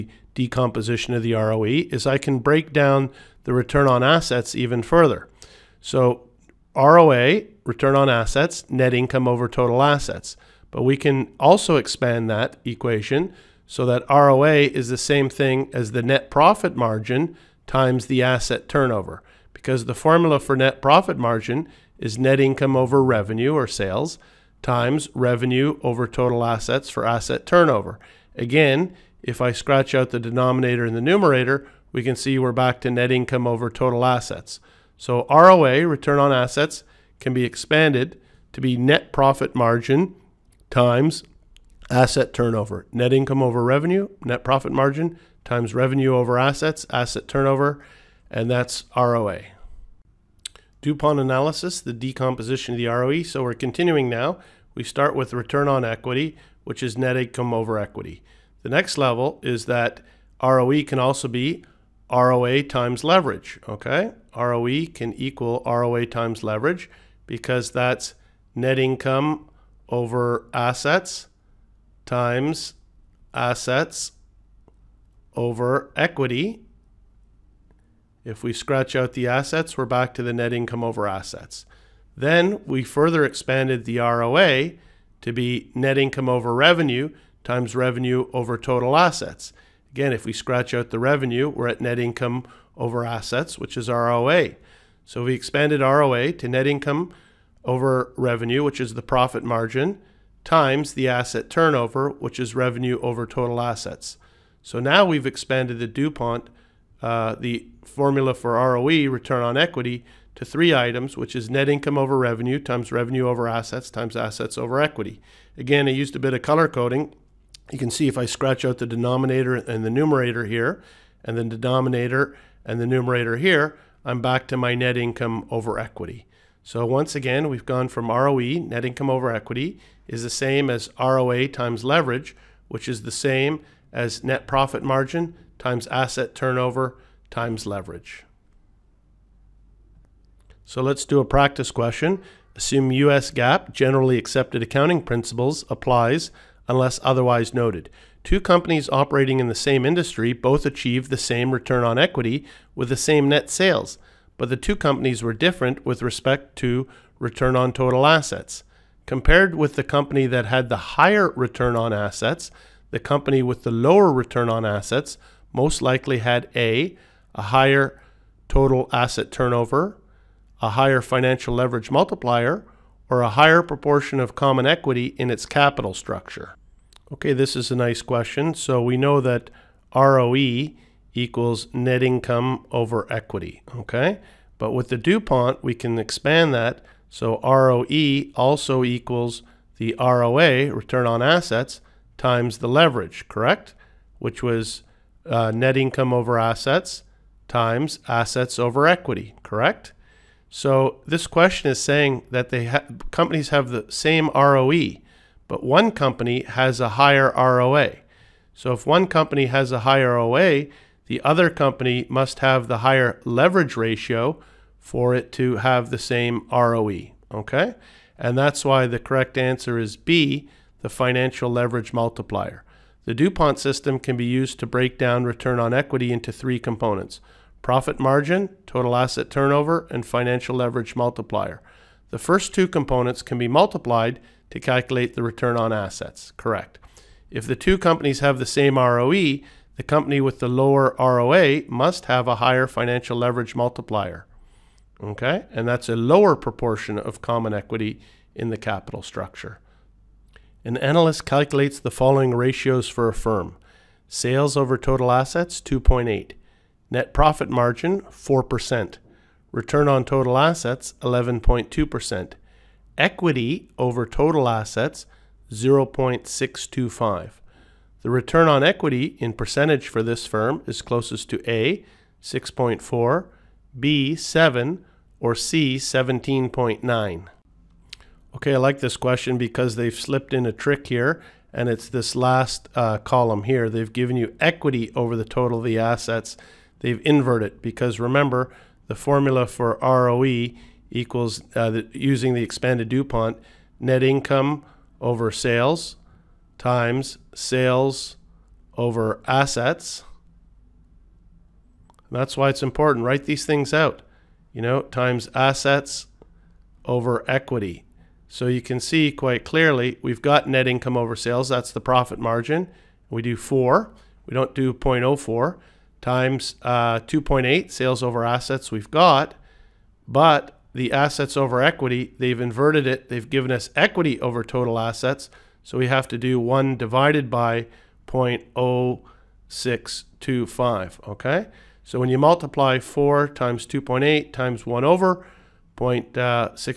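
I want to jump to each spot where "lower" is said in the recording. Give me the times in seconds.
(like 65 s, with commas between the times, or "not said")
163 s, 240 s, 245 s.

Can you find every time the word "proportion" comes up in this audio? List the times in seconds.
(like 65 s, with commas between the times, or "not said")
173 s, 246 s.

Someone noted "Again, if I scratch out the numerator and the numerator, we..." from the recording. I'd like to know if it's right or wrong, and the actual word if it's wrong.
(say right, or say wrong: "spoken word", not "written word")
wrong: "denominator", not "numerator".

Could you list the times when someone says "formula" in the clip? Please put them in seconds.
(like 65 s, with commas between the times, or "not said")
19 s, 107 s, 288 s.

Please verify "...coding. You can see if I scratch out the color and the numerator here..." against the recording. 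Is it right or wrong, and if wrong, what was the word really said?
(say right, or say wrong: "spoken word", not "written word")
wrong: "denominator", not "color".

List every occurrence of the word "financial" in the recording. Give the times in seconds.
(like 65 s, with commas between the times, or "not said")
171 s, 220 s, 230 s, 242 s.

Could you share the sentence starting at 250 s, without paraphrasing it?
An analyst calculates the following ratios for a firm.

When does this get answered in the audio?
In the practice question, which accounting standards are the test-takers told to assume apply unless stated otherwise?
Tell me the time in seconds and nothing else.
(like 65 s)
142 s.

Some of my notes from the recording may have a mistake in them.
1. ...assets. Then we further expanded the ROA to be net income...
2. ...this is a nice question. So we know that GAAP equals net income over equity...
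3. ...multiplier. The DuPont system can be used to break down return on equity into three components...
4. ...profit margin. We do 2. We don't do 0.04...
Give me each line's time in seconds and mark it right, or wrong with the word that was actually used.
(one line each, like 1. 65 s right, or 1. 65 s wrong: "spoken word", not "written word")
1. 81 s right
2. 177 s wrong: "ROE", not "GAAP"
3. 221 s right
4. 311 s wrong: "4", not "2".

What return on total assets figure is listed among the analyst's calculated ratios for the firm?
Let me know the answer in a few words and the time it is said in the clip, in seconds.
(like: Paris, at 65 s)
11.2%, at 261 s.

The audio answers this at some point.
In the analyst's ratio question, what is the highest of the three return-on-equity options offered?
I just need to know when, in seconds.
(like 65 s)
275 s.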